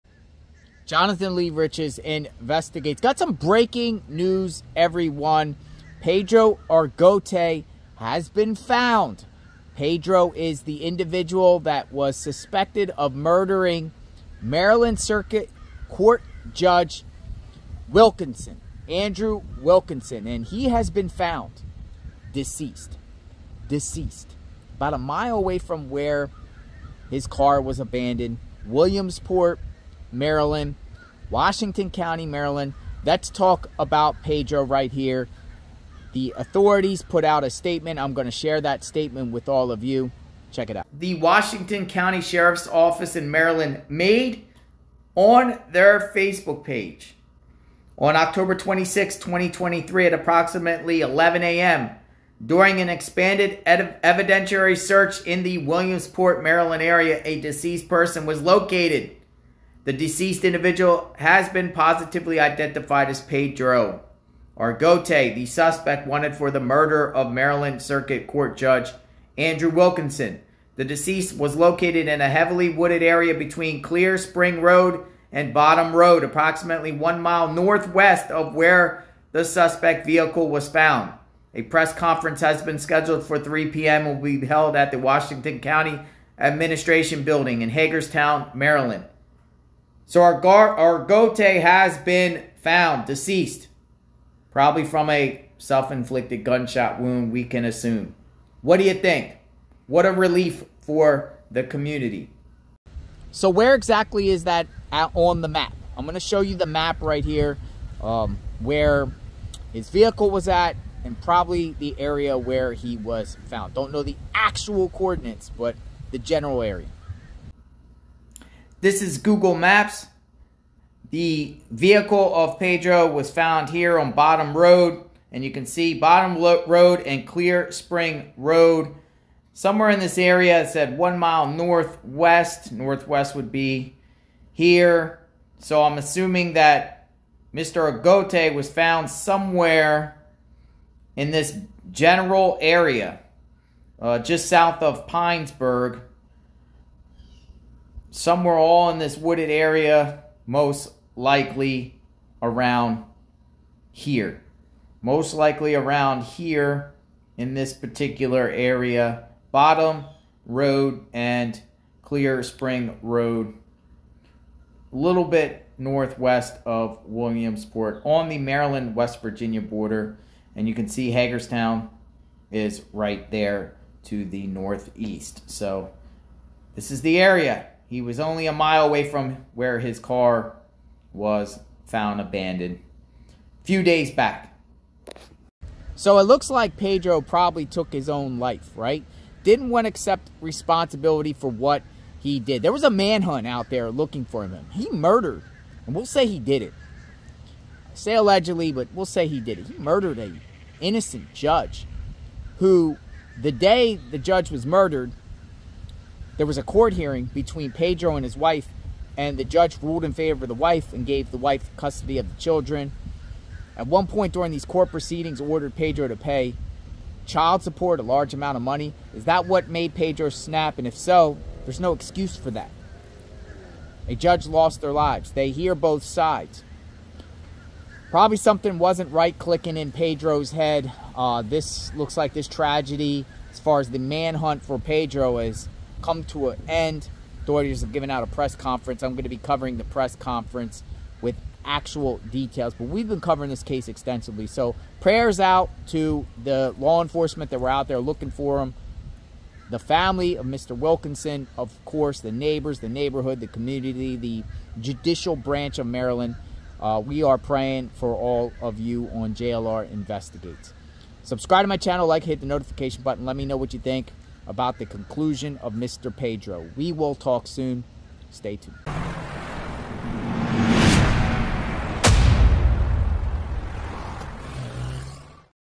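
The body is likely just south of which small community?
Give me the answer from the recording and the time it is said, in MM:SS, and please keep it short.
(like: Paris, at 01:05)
Pinesburg, at 02:25.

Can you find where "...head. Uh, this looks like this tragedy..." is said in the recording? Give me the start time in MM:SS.
03:50.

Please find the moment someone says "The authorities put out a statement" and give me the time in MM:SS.
00:36.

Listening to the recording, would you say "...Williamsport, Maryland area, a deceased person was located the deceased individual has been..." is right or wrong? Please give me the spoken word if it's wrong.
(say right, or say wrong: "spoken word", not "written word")
right.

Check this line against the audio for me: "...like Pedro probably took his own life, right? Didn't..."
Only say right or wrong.
right.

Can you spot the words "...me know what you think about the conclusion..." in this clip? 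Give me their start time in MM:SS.
04:23.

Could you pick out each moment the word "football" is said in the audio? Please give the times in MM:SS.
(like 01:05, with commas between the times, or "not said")
not said.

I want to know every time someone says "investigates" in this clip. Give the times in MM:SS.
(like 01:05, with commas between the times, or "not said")
00:01, 04:19.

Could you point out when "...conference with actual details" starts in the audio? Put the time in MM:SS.
04:00.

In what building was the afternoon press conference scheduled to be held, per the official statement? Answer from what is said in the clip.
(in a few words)
Washington County Administration Building.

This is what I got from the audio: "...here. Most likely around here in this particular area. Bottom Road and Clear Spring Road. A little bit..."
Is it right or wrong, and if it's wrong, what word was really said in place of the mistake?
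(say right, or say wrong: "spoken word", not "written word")
right.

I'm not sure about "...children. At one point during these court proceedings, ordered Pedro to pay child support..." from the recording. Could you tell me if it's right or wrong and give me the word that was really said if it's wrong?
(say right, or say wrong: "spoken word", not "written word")
right.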